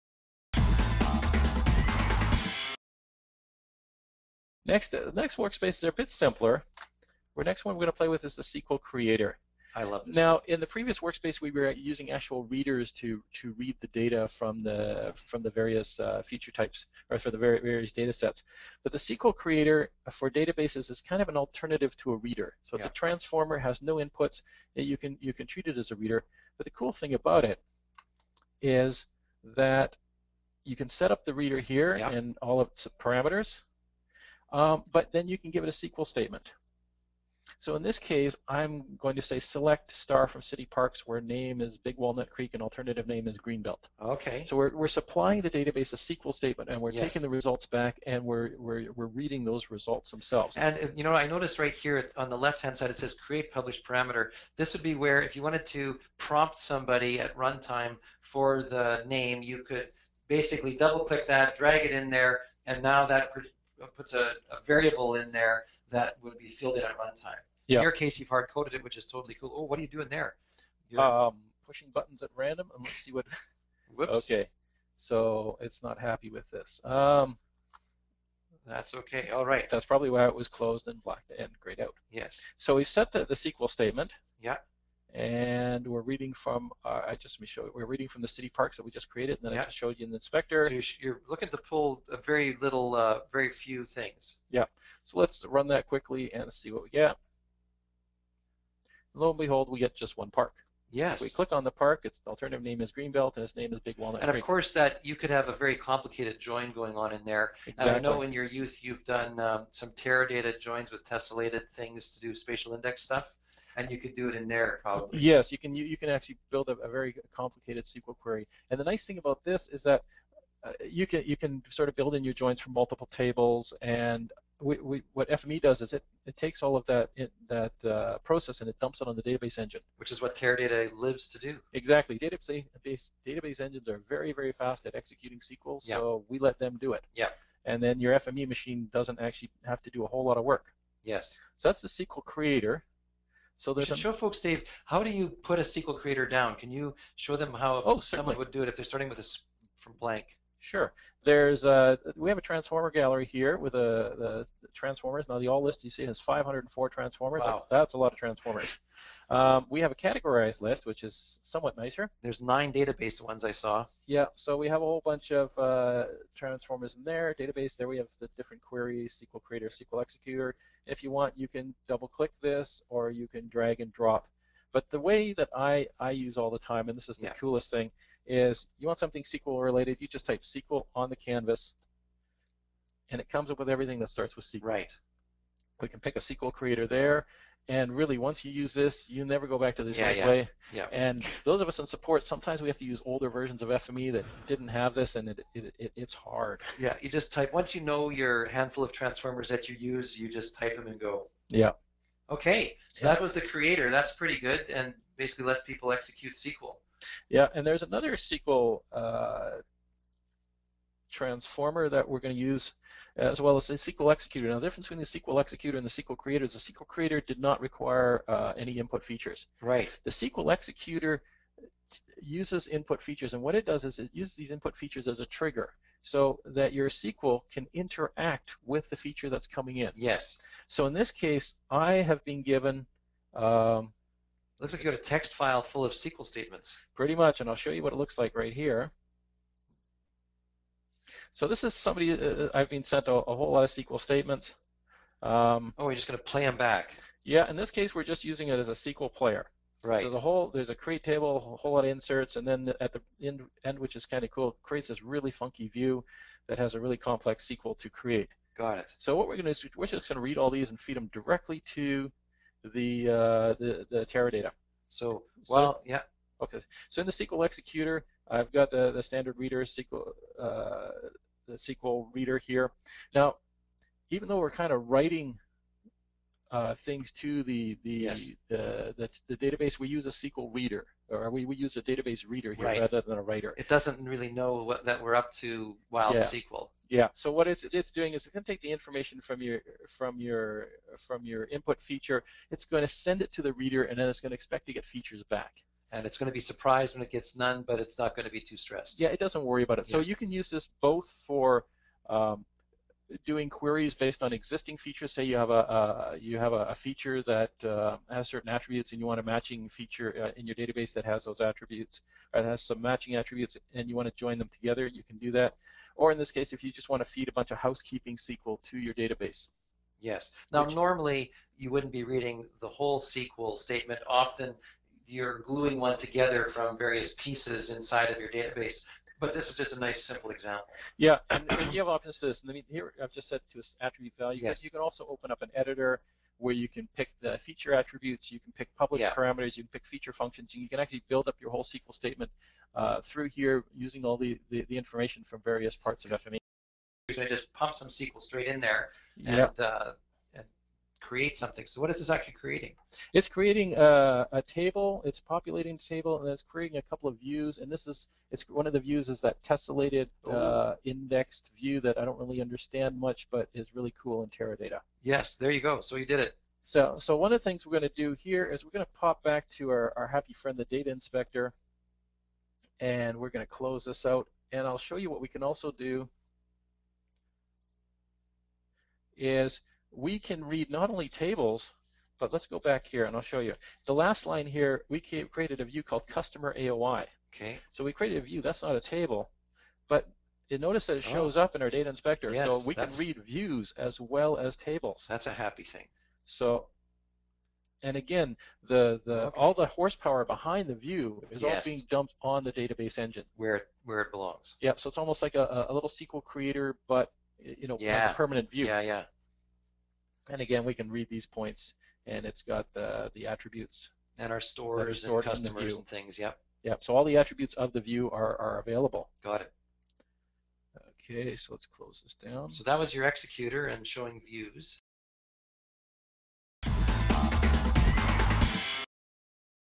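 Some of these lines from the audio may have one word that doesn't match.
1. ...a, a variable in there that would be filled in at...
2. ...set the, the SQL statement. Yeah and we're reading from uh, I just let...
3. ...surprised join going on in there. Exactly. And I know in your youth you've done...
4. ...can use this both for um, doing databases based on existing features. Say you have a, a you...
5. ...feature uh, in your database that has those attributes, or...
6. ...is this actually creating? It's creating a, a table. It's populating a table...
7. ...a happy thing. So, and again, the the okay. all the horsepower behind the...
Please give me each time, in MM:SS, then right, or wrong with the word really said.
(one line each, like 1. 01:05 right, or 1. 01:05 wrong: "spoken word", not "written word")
1. 01:04 right
2. 01:22 right
3. 01:45 wrong: "complicated", not "surprised"
4. 05:00 wrong: "queries", not "databases"
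5. 05:09 right
6. 05:51 right
7. 06:35 right.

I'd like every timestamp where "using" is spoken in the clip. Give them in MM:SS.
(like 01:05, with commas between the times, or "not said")
00:11, 04:08, 05:43.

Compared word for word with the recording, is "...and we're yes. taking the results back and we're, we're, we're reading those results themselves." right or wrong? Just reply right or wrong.
right.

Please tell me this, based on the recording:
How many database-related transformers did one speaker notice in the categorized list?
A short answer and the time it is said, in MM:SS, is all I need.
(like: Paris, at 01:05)
9, at 02:42.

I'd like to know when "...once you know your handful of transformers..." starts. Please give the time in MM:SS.
03:17.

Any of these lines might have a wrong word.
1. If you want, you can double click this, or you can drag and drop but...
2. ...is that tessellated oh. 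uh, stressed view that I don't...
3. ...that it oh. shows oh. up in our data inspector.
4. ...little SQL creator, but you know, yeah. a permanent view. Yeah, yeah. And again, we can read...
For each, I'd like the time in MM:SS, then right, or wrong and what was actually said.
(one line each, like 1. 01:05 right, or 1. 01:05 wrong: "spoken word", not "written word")
1. 02:50 right
2. 05:59 wrong: "indexed", not "stressed"
3. 06:30 right
4. 06:45 right.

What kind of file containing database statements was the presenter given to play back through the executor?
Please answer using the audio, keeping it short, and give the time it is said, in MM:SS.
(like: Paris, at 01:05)
text file, at 03:55.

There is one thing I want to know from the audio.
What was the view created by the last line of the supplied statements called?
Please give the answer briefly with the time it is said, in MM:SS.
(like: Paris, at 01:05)
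customer AOI, at 06:26.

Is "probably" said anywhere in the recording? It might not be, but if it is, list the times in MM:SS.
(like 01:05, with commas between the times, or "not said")
01:19, 01:54.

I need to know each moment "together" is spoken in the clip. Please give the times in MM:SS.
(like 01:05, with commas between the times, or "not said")
05:14, 05:25.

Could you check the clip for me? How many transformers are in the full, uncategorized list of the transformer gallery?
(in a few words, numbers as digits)
504.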